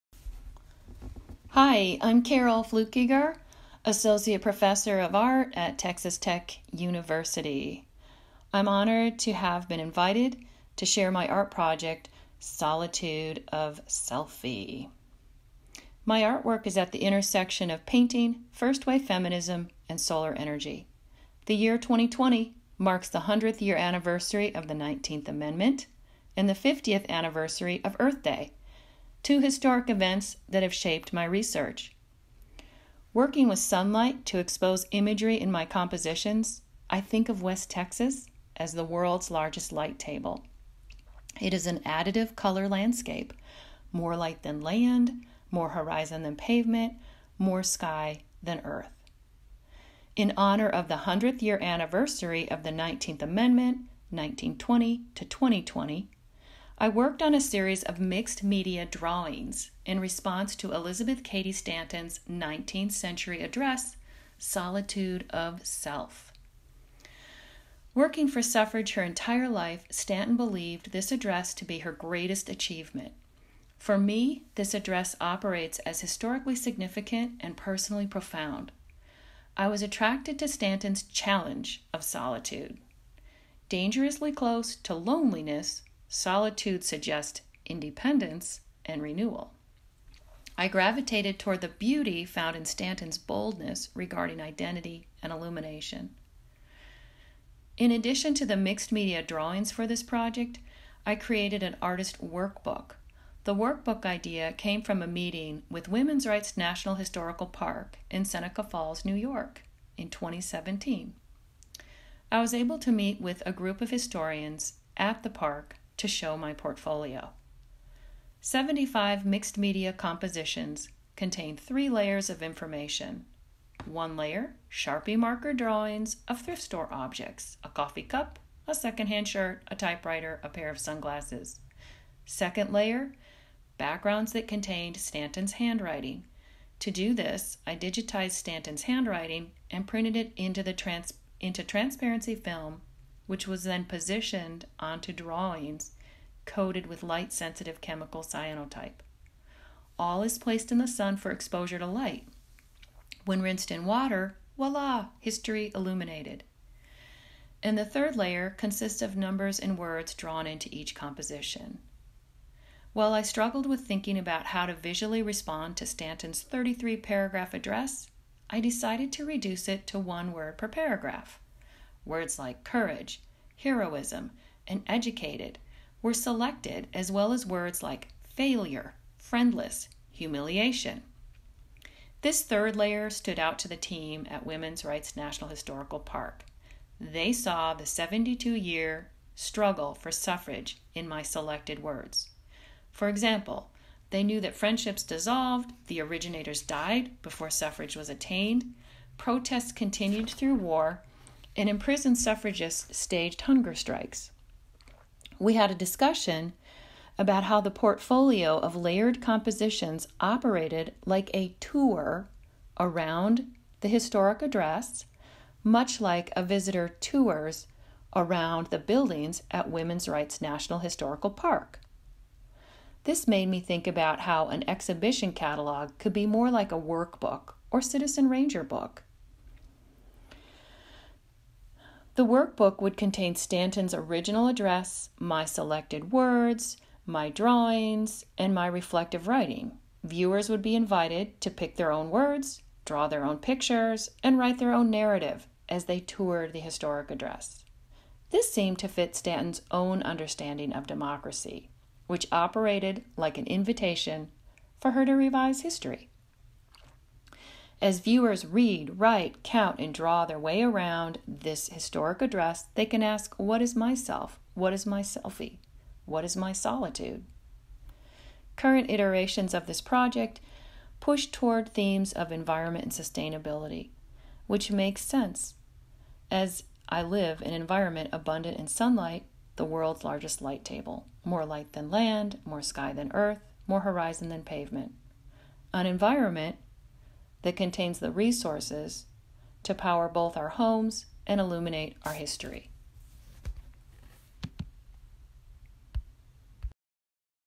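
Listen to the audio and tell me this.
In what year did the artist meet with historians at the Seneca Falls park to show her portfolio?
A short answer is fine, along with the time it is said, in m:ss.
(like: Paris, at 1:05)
2017, at 1:50.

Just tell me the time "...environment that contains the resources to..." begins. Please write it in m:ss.
4:45.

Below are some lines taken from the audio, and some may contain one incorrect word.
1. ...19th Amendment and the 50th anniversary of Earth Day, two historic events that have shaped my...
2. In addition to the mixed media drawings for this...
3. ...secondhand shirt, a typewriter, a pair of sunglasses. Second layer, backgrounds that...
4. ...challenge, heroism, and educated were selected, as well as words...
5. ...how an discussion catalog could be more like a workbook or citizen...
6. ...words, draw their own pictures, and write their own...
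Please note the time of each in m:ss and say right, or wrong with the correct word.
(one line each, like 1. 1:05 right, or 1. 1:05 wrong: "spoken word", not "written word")
1. 0:24 right
2. 1:37 right
3. 2:08 right
4. 2:52 wrong: "courage", not "challenge"
5. 3:44 wrong: "exhibition", not "discussion"
6. 4:02 right.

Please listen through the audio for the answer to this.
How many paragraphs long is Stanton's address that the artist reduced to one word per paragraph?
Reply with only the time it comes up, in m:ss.
2:46.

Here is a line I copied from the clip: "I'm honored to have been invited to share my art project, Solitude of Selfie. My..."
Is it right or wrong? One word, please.
right.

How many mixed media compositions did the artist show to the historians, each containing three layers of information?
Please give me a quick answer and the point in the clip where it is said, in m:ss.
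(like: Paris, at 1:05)
75, at 1:58.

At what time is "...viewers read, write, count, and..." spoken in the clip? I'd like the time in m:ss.
4:17.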